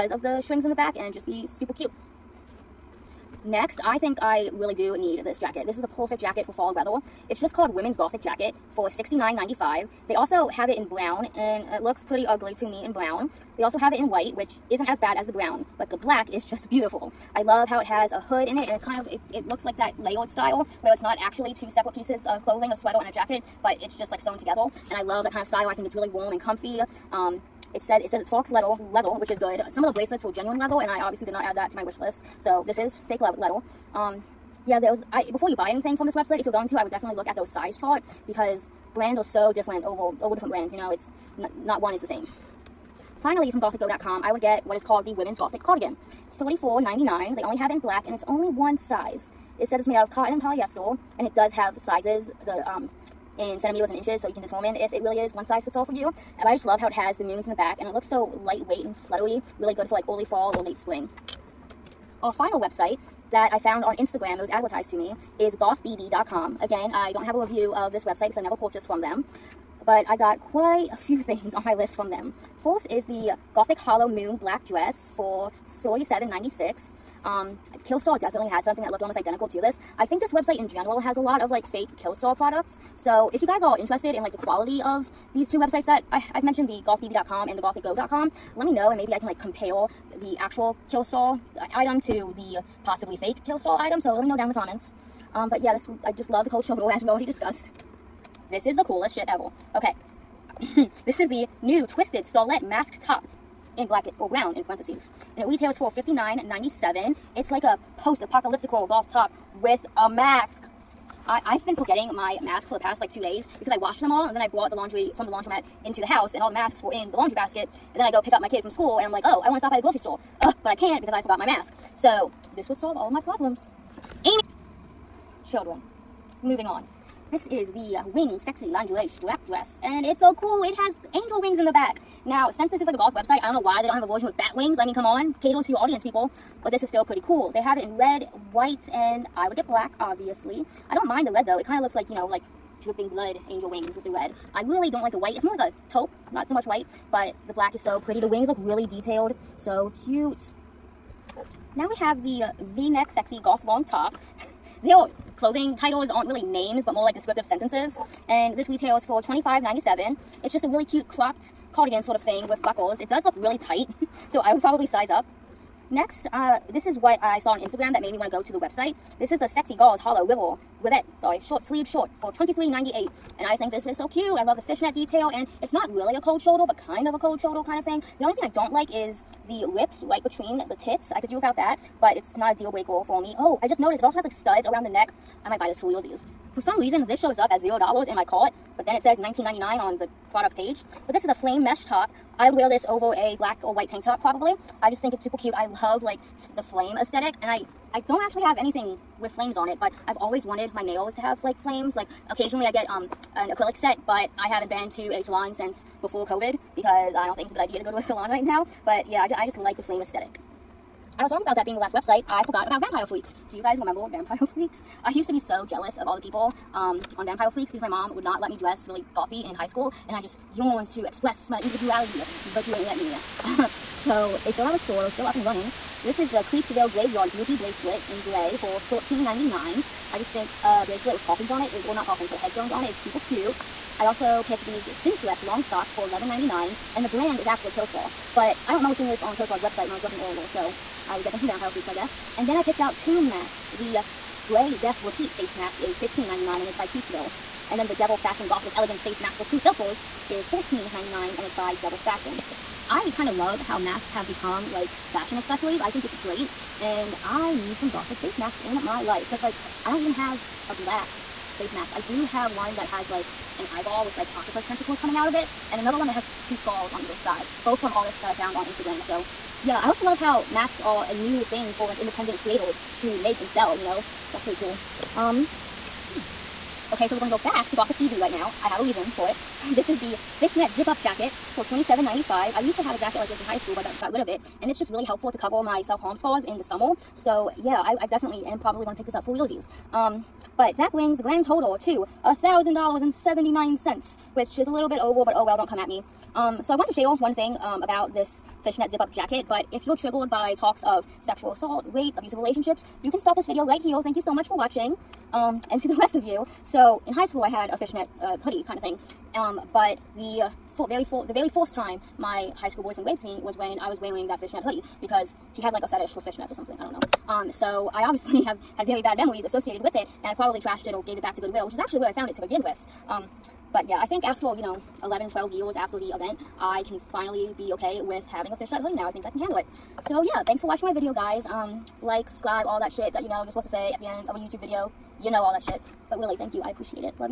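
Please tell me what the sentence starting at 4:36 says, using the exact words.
Okay, so we're going to go back to Gothic BB right now.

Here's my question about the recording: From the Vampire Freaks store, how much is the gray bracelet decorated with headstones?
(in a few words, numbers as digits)
$13.99.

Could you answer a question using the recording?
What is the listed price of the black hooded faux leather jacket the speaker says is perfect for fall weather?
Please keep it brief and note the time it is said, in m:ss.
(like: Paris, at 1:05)
$69.95, at 0:08.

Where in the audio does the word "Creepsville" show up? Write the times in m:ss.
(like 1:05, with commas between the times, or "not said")
3:46, 4:06.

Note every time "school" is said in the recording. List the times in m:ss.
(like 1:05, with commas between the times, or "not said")
1:58, 3:39, 4:43, 5:07, 5:12.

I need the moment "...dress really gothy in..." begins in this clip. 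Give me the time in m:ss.
3:38.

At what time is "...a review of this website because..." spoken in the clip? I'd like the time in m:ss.
1:07.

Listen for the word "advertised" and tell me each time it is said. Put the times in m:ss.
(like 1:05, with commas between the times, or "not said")
1:04.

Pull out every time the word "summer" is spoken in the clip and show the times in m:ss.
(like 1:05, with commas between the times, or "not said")
4:46.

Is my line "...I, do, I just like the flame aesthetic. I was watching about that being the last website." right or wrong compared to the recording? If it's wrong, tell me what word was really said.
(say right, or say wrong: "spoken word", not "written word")
wrong: "wrong", not "watching".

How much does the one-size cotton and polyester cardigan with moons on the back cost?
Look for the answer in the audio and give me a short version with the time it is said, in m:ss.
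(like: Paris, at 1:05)
$34.99, at 0:46.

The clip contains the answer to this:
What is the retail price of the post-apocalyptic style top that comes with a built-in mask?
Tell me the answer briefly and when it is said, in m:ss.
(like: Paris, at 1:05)
$59.97, at 1:45.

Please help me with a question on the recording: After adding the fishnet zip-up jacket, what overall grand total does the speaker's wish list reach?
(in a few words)
$1,000.79.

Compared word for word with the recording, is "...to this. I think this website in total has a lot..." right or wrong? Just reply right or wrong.
wrong.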